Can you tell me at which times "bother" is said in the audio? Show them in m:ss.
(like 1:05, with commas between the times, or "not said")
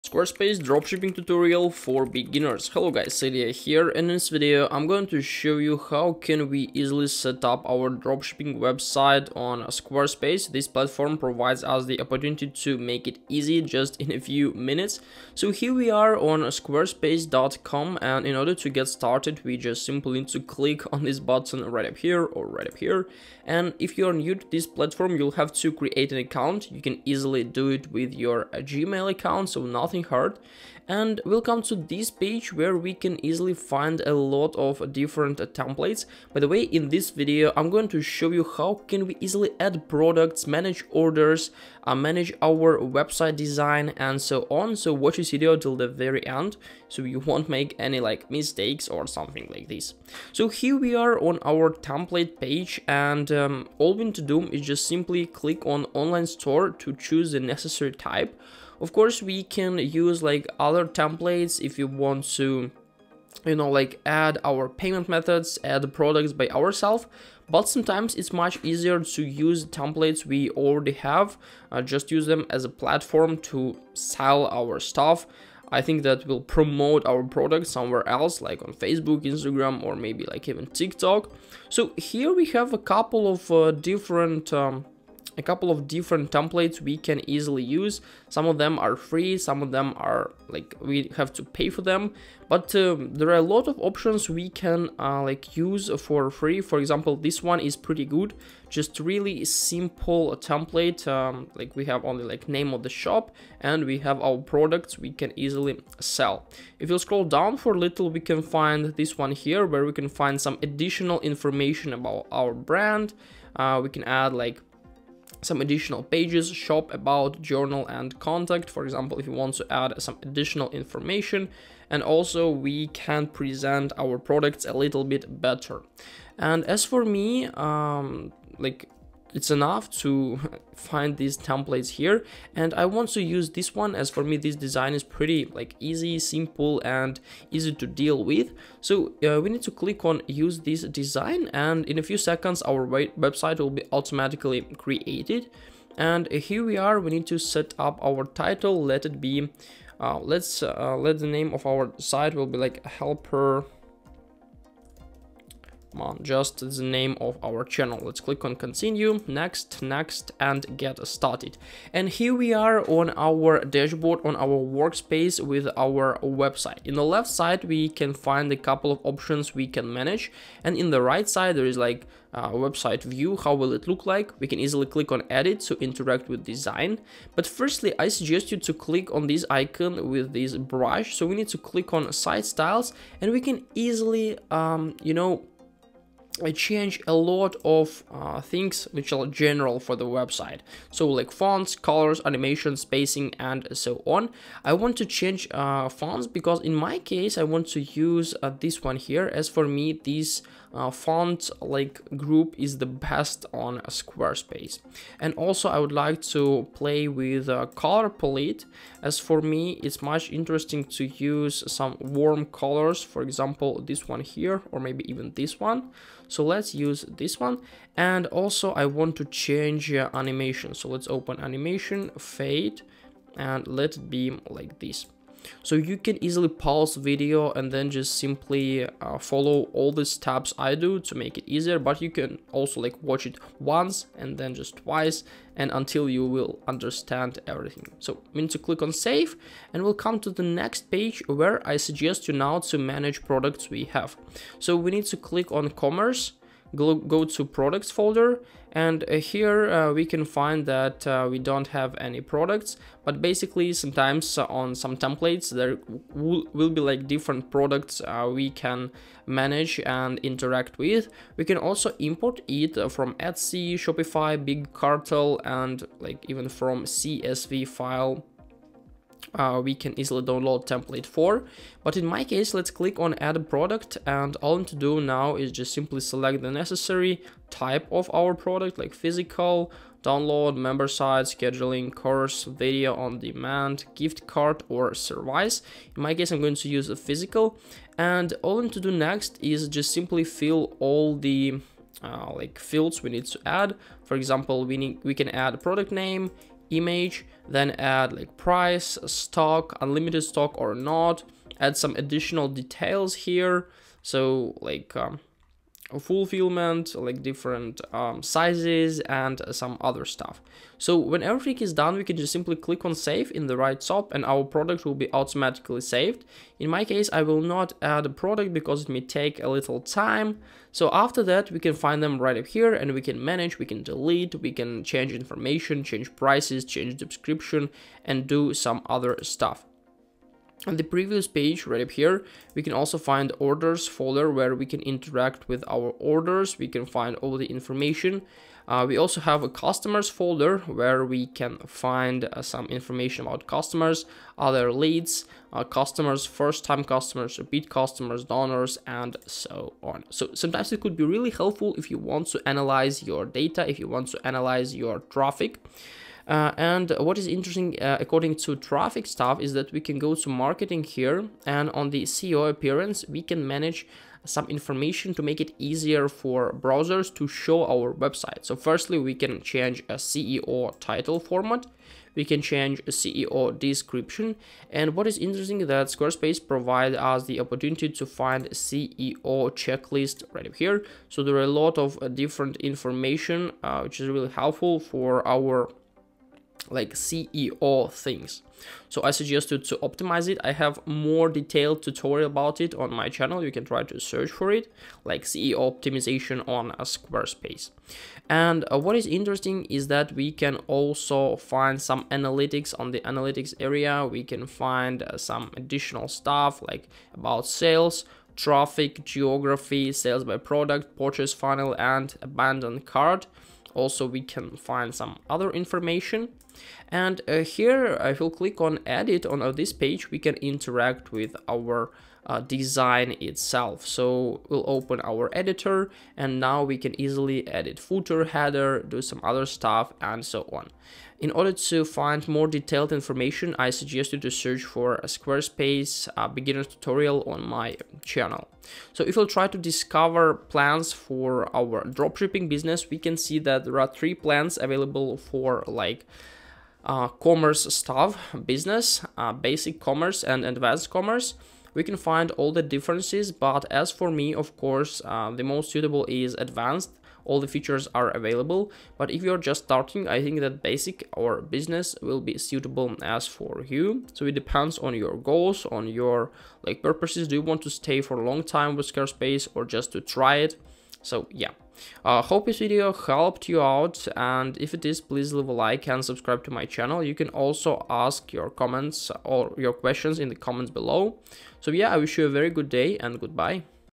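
not said.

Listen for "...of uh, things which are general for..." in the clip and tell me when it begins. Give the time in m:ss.
3:07.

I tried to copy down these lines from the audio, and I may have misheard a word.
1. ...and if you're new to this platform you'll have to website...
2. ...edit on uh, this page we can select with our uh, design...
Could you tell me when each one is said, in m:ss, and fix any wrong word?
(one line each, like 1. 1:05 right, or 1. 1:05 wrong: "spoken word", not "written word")
1. 0:23 wrong: "create", not "website"
2. 6:58 wrong: "interact", not "select".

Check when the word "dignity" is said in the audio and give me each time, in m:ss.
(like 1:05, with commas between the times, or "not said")
not said.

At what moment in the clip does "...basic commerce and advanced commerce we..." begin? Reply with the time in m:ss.
7:29.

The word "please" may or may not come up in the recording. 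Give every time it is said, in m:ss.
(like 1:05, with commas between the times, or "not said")
7:55.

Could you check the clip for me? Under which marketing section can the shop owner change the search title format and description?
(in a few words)
SEO appearance.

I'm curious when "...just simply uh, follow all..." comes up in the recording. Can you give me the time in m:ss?
3:47.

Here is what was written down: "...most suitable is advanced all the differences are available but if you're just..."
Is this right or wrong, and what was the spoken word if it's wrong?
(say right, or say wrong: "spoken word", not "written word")
wrong: "features", not "differences".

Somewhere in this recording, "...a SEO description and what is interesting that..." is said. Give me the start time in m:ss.
6:12.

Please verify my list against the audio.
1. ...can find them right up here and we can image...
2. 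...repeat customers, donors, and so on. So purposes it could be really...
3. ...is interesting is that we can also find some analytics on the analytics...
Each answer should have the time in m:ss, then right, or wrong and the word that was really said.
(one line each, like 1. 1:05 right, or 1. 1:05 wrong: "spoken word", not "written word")
1. 5:21 wrong: "manage", not "image"
2. 5:47 wrong: "sometimes", not "purposes"
3. 6:38 right.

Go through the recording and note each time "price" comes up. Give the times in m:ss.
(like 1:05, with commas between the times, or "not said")
4:58, 5:26.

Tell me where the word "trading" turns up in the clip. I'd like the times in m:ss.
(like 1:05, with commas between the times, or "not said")
not said.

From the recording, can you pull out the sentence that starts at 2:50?
And in the right side, there is like website view, how will it look like?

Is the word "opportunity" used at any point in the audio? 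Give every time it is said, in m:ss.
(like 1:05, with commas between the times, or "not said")
0:12, 6:17.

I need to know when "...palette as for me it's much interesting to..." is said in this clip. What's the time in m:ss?
3:28.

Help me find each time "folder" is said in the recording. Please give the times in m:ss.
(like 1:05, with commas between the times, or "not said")
4:07, 5:33, 5:40.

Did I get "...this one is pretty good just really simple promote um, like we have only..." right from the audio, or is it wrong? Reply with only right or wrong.
wrong.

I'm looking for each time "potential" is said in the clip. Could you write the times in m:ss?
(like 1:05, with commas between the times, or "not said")
not said.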